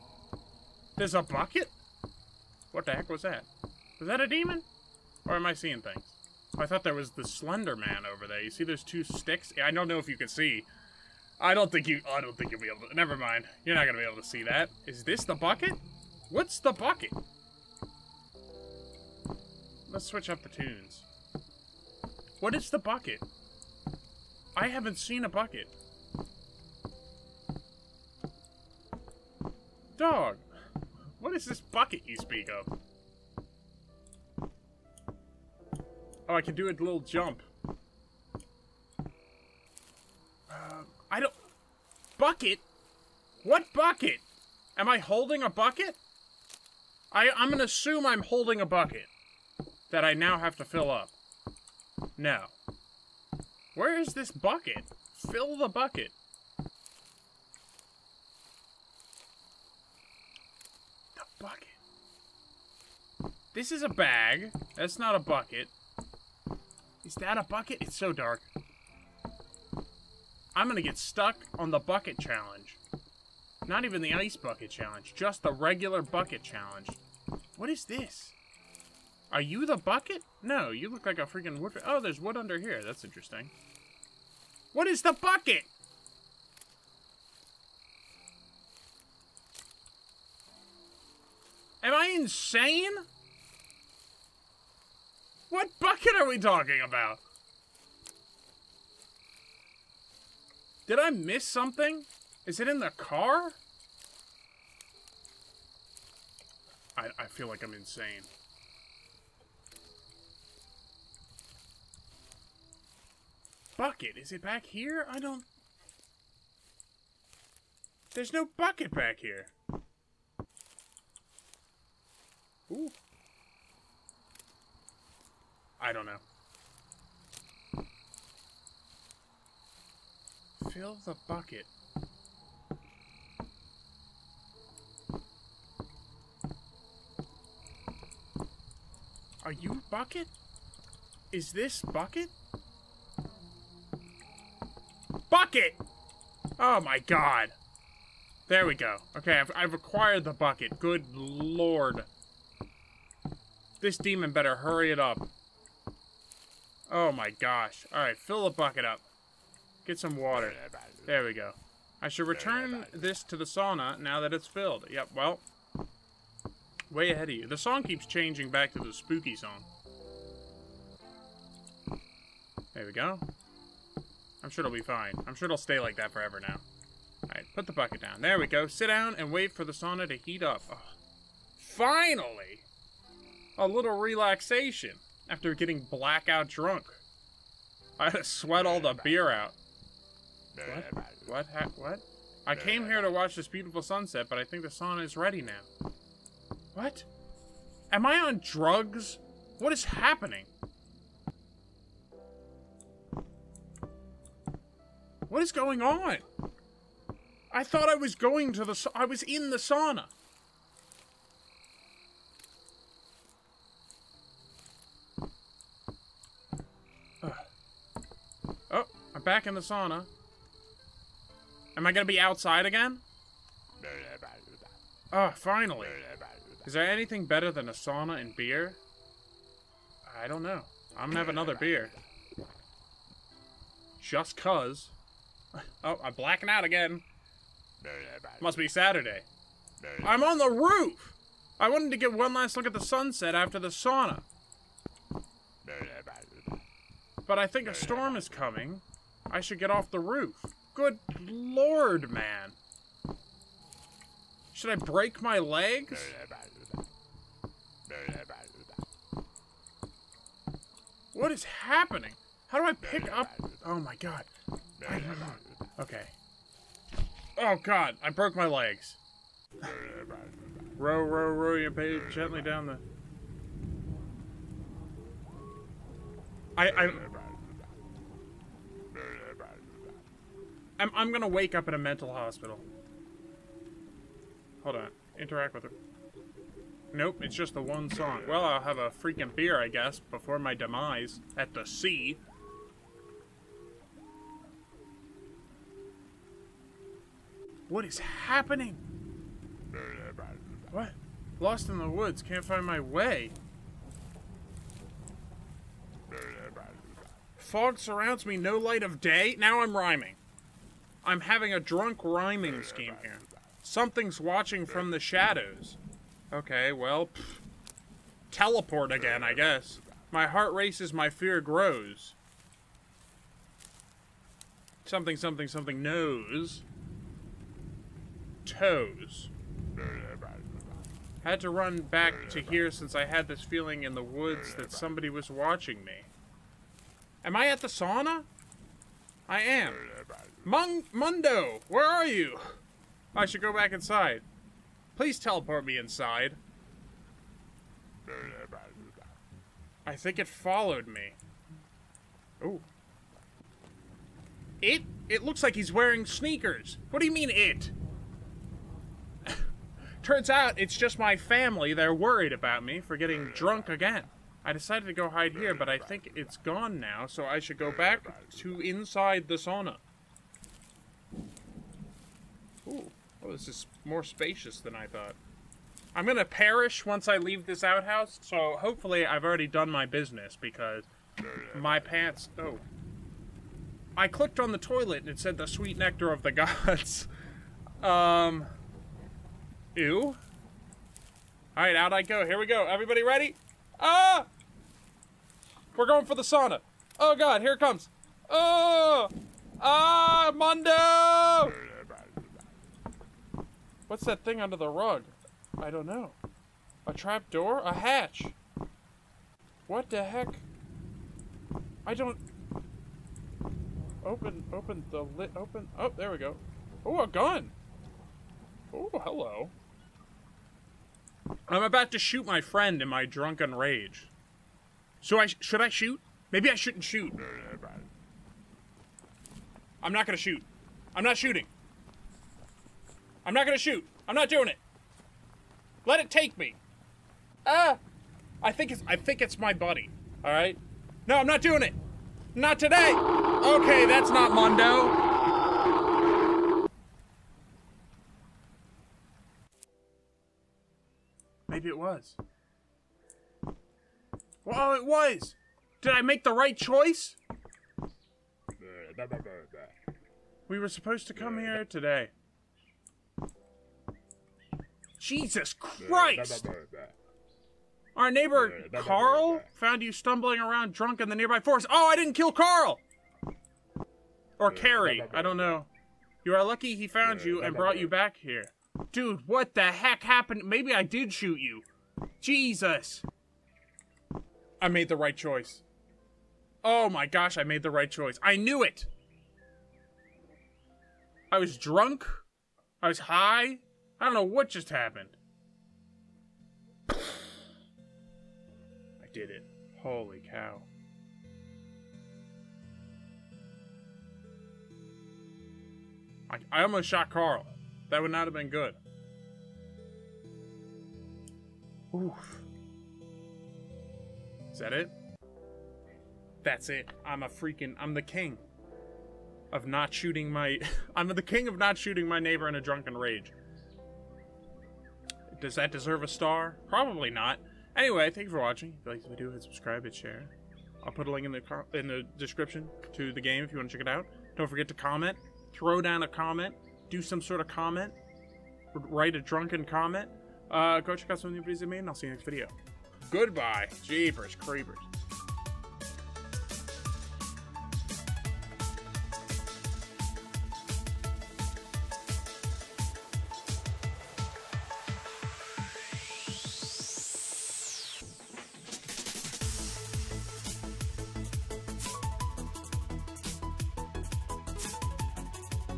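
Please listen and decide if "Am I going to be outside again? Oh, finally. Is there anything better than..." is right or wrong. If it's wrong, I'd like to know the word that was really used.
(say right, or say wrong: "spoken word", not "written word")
right.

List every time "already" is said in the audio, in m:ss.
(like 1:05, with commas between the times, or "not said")
6:19.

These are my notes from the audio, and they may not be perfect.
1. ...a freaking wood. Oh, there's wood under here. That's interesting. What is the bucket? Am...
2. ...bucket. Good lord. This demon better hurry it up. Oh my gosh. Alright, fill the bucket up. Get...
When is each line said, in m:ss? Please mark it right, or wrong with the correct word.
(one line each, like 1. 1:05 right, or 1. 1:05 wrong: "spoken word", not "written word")
1. 1:21 right
2. 2:30 right.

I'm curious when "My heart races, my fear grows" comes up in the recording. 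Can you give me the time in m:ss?
5:20.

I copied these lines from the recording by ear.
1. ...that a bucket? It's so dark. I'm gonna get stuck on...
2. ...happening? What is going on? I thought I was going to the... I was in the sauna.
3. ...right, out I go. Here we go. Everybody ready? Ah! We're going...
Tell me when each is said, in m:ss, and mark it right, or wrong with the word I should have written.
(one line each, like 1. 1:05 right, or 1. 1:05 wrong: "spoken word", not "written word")
1. 1:07 right
2. 3:19 right
3. 6:31 right.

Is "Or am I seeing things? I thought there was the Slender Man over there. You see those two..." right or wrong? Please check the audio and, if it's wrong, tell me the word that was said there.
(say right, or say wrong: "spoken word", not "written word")
right.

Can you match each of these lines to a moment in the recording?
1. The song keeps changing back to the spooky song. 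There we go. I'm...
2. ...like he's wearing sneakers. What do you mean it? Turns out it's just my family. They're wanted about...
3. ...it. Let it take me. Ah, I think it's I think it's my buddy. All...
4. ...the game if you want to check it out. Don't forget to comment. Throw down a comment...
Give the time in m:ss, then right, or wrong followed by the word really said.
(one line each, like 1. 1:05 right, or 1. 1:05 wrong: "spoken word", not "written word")
1. 2:47 right
2. 5:55 wrong: "worried", not "wanted"
3. 7:14 right
4. 8:53 right.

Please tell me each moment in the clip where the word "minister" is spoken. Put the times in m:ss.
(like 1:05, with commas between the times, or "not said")
not said.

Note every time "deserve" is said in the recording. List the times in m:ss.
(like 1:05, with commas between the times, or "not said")
8:45.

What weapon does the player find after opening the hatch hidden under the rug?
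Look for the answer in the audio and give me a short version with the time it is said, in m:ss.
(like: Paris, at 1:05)
A gun, at 6:57.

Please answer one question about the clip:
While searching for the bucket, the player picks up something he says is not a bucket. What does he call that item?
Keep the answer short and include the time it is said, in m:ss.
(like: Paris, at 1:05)
A bag, at 1:03.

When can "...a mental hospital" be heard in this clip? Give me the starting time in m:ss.
4:41.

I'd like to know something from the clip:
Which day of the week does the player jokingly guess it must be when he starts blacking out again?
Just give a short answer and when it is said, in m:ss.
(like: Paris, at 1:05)
Saturday, at 3:58.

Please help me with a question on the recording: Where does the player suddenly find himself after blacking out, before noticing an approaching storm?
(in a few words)
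On the roof.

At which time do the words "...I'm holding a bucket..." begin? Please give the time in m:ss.
0:48.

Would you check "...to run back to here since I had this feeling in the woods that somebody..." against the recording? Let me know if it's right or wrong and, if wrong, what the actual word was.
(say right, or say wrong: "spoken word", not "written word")
right.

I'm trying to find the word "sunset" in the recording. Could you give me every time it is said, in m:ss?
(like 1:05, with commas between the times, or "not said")
3:13, 4:02.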